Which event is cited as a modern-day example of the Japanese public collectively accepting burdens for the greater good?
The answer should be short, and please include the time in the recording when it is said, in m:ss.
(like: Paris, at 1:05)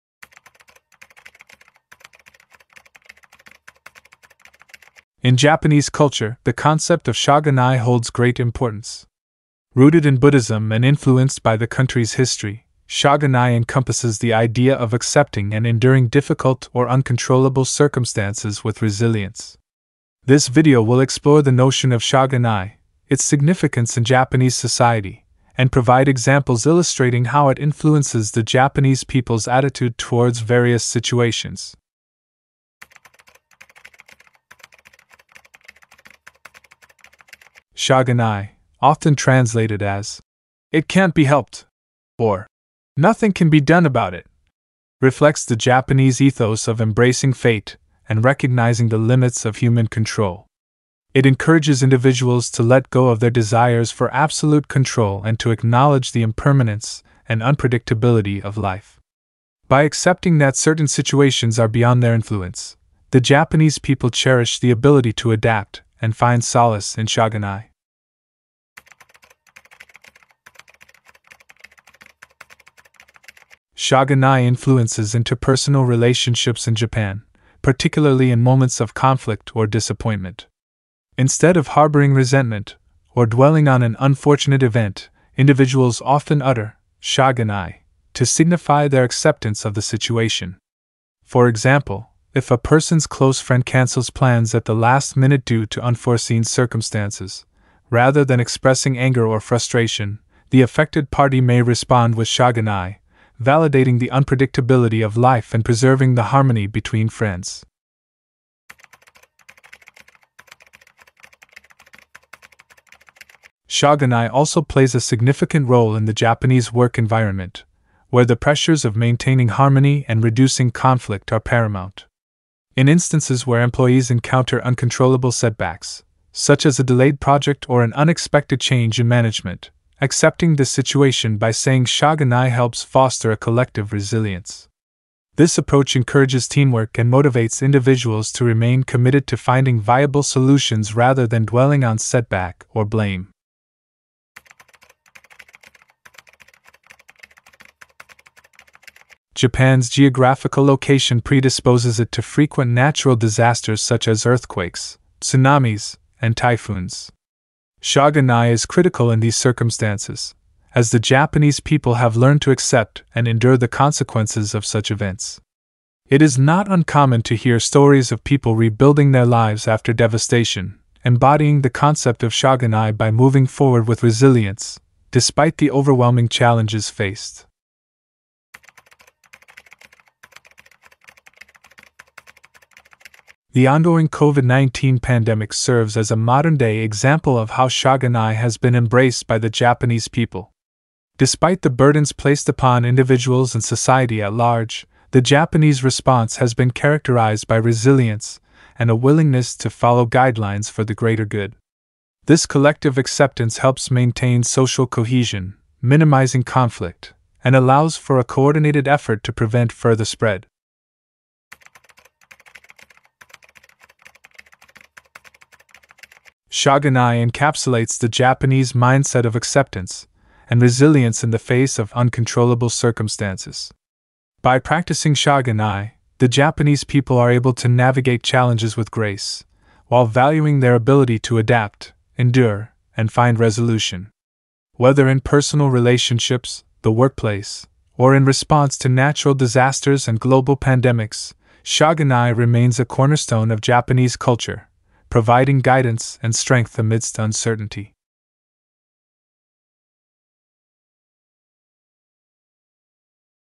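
COVID-19 pandemic, at 3:04.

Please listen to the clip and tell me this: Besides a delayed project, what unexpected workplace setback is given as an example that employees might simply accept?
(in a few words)
change in management.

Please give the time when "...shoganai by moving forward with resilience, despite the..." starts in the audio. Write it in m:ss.
2:52.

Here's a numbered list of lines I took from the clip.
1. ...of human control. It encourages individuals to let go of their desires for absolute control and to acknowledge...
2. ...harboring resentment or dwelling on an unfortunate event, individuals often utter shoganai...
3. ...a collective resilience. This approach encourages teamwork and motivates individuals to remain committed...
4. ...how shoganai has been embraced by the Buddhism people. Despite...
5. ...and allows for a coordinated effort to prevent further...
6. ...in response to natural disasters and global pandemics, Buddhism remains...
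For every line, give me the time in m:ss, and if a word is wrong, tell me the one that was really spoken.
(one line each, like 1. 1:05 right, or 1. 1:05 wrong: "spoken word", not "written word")
1. 0:49 right
2. 1:21 right
3. 2:13 right
4. 3:07 wrong: "Japanese", not "Buddhism"
5. 3:27 right
6. 3:58 wrong: "Shoganai", not "Buddhism".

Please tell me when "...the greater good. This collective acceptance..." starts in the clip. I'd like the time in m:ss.
3:20.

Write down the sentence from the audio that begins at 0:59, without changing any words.
By accepting that certain situations are beyond their influence, the Japanese people cherish the ability to adapt and find solace in shoganai.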